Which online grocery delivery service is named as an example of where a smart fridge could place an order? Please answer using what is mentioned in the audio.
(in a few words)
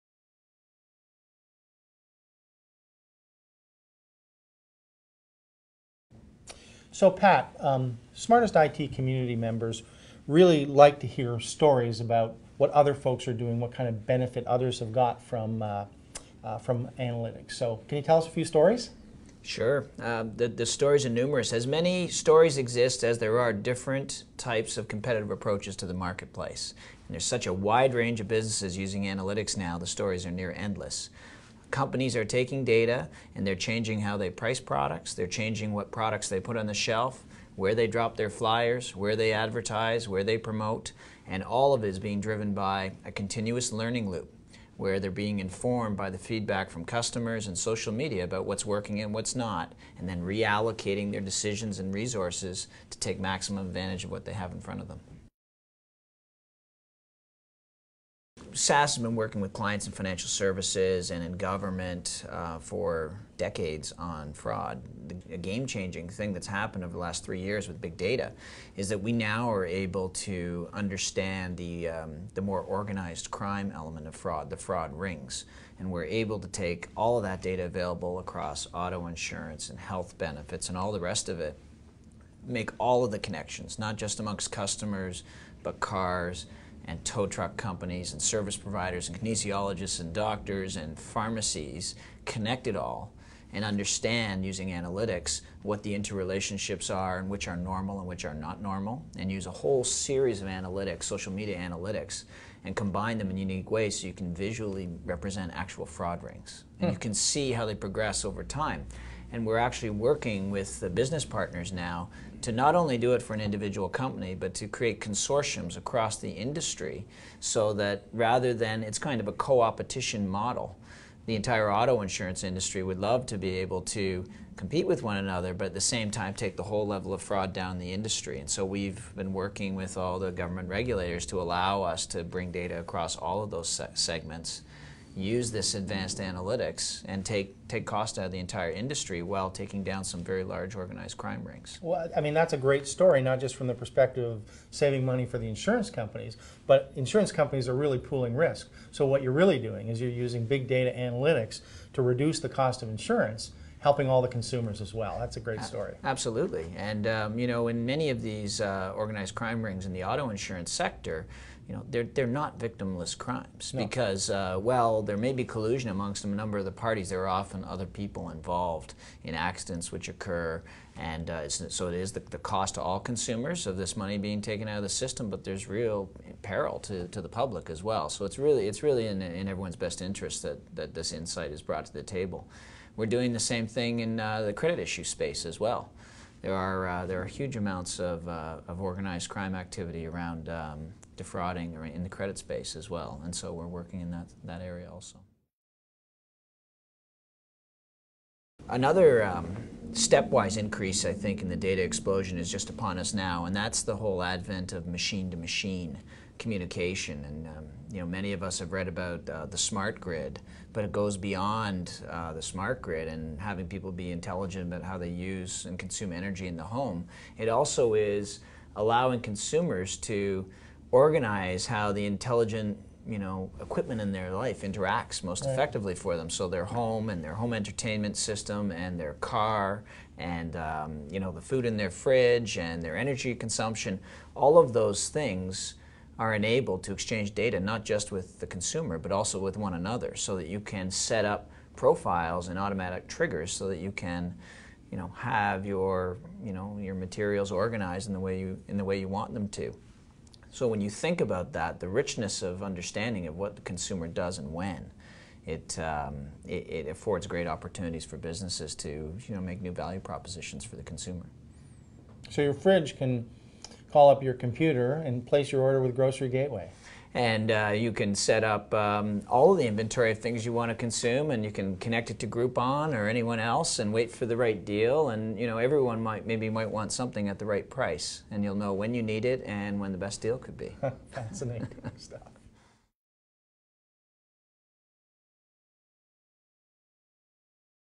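Grocery Gateway.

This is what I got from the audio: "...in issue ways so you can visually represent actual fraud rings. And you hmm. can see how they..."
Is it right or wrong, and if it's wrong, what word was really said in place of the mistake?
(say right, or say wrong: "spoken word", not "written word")
wrong: "unique", not "issue".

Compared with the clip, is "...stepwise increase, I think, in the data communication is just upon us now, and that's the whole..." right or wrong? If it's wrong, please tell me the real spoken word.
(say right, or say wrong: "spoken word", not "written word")
wrong: "explosion", not "communication".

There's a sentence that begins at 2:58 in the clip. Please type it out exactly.
So it's really, it's really in, in everyone's best interest that, that this insight is brought to the table.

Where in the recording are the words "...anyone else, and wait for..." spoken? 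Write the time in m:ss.
4:33.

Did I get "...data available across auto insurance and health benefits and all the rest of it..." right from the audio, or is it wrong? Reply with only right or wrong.
right.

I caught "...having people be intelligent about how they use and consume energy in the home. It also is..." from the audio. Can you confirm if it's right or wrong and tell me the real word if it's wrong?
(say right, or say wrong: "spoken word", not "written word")
right.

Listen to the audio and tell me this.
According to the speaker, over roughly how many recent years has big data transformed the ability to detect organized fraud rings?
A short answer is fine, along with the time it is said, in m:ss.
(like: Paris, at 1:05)
3 years, at 1:07.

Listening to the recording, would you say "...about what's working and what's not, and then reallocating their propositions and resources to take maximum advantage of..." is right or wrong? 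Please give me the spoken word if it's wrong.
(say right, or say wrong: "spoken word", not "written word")
wrong: "decisions", not "propositions".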